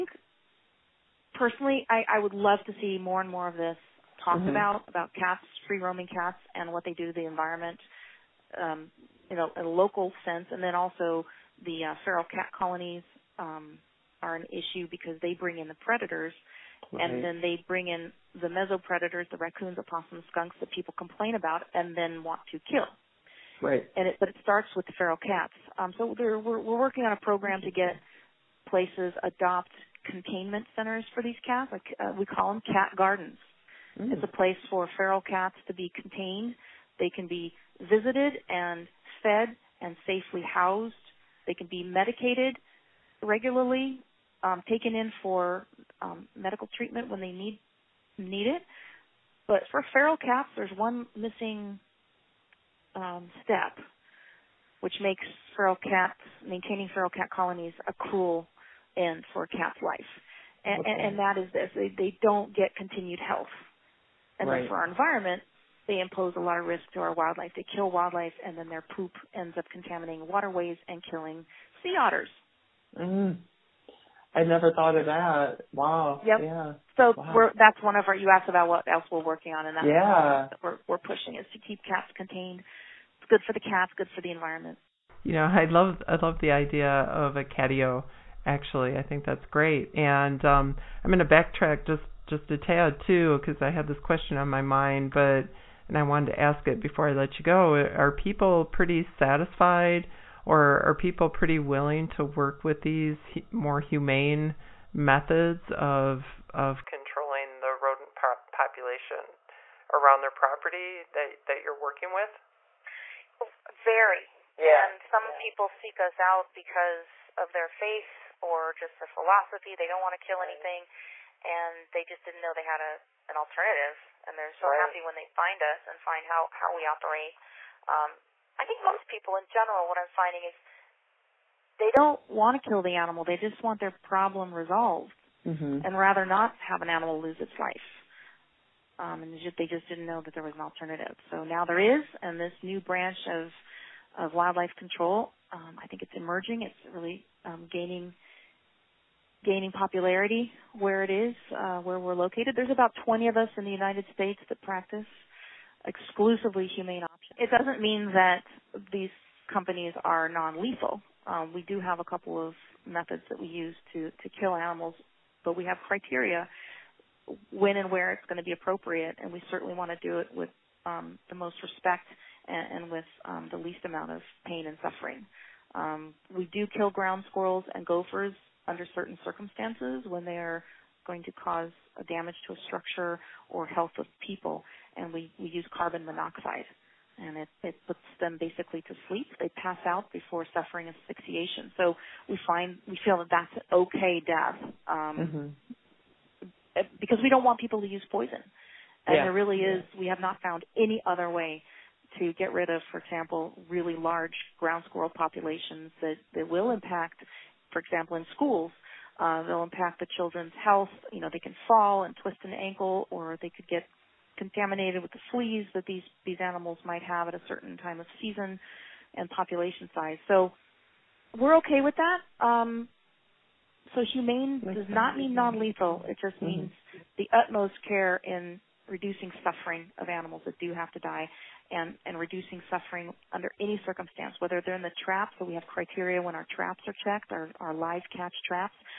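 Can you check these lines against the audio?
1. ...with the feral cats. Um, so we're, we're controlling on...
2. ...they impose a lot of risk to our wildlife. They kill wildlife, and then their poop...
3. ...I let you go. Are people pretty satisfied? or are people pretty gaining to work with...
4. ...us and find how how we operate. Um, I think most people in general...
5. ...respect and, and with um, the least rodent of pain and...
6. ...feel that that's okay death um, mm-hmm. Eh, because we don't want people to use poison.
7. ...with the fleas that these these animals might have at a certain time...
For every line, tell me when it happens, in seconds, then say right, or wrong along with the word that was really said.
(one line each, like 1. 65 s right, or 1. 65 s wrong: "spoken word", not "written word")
1. 24 s wrong: "working", not "controlling"
2. 65 s right
3. 97 s wrong: "willing", not "gaining"
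4. 125 s right
5. 171 s wrong: "amount", not "rodent"
6. 193 s right
7. 215 s right.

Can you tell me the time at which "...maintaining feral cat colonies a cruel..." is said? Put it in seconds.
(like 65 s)
56 s.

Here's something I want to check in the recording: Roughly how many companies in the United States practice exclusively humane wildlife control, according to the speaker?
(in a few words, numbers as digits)
20.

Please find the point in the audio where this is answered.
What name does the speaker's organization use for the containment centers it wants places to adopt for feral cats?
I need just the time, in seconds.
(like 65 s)
32 s.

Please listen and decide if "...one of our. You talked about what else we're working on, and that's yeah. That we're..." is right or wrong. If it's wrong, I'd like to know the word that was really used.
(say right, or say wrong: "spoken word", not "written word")
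wrong: "asked", not "talked".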